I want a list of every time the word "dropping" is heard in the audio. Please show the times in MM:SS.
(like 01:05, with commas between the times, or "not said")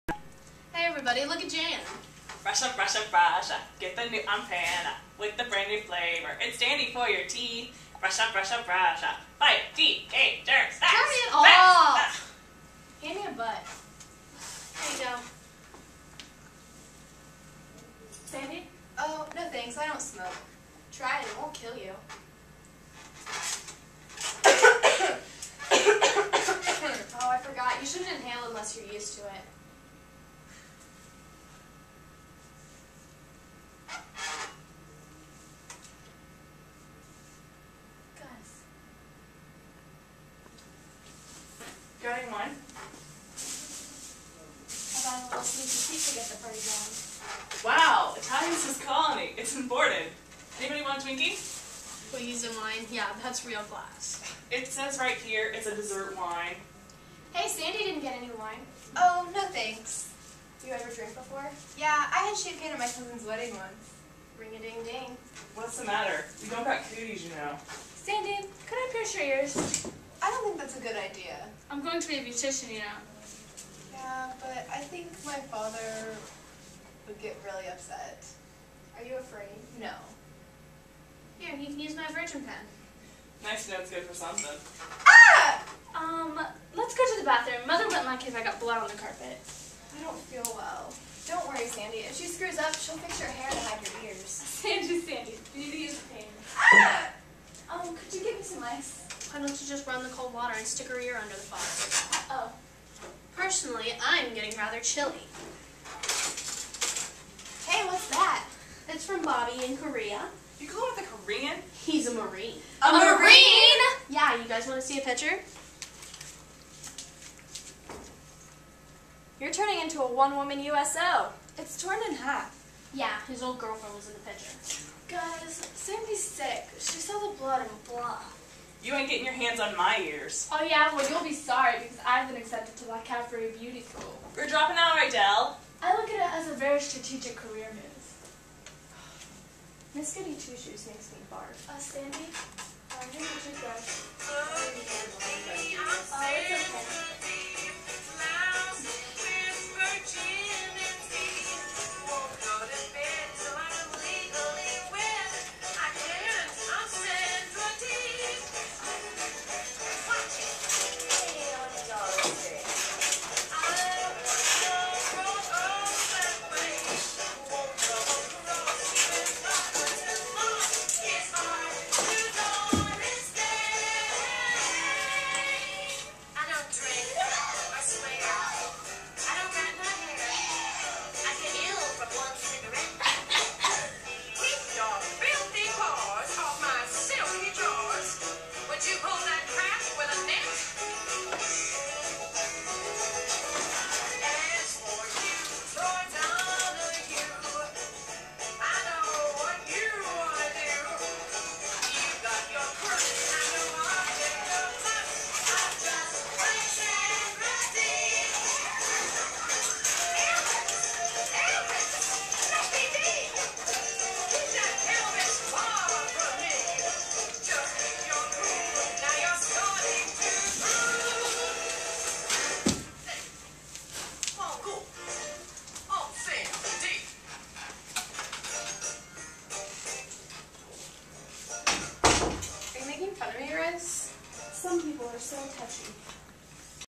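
02:14.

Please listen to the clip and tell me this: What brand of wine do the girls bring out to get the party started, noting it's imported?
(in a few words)
Italian Swiss Colony.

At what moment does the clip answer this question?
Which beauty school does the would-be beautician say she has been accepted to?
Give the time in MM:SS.
02:12.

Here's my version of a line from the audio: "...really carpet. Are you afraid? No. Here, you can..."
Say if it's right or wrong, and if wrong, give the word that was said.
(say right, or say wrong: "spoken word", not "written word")
wrong: "upset", not "carpet".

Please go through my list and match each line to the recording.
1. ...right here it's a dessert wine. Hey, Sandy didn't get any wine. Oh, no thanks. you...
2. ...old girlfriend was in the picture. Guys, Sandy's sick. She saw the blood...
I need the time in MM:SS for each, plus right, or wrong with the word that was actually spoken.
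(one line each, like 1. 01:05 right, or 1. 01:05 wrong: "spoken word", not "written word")
1. 00:54 right
2. 02:03 right.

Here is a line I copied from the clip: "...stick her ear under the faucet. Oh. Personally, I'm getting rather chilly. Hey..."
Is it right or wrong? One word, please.
right.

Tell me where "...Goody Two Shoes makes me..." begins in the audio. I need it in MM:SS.
02:20.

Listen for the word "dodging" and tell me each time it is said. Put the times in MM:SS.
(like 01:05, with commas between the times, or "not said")
not said.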